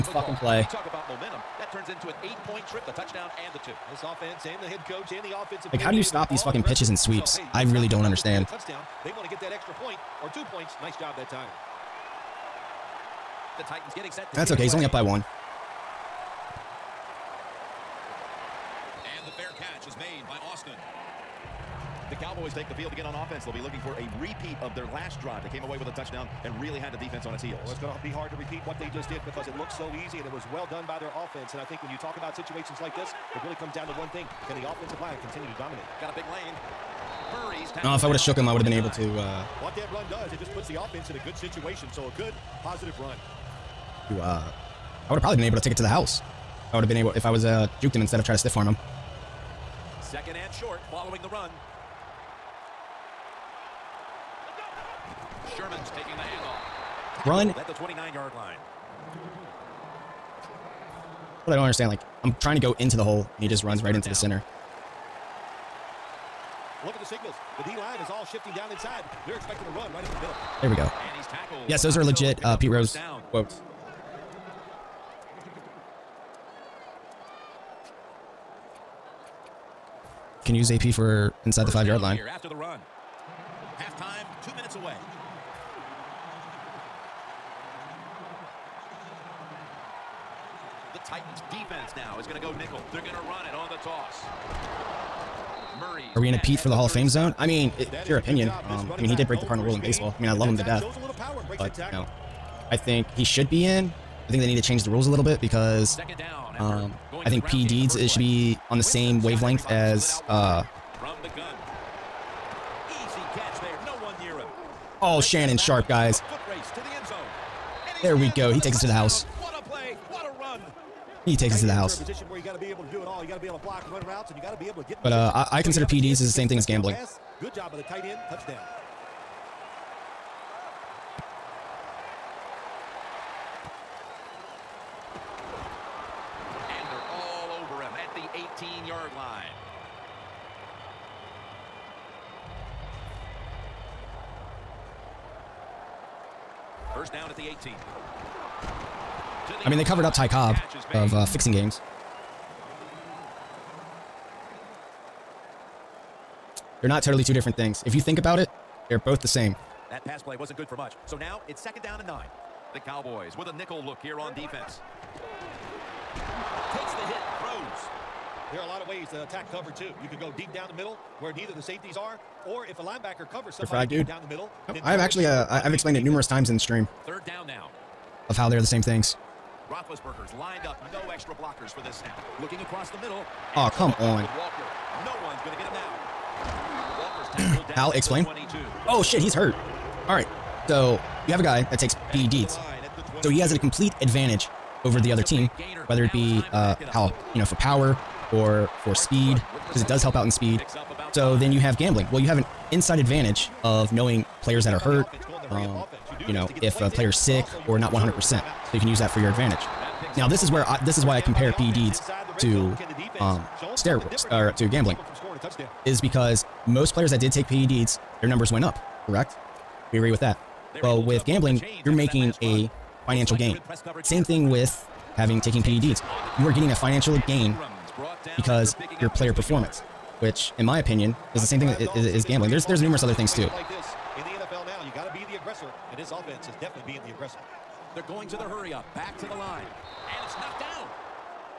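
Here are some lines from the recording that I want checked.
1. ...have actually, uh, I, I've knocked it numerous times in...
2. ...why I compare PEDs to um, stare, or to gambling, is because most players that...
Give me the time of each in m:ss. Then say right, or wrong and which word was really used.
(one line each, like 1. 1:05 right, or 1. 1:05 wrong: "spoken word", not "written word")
1. 2:54 wrong: "explained", not "knocked"
2. 3:31 right.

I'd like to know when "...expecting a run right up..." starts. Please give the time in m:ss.
1:09.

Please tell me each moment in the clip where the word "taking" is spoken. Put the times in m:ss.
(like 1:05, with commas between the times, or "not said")
0:55, 3:45.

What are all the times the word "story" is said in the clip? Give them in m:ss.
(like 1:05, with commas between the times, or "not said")
not said.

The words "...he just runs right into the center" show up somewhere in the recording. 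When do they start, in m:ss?
1:03.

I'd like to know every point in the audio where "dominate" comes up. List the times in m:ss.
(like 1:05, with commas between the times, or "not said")
0:35.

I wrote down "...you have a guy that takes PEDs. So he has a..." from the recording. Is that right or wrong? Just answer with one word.
right.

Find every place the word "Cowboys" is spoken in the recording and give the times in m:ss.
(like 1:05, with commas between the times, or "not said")
0:22, 2:42.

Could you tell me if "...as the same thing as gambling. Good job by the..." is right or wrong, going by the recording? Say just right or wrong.
right.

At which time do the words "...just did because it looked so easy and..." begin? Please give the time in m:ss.
0:28.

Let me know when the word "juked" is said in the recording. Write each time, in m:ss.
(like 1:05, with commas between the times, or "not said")
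0:47.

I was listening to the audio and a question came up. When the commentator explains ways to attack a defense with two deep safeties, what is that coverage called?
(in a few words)
cover two.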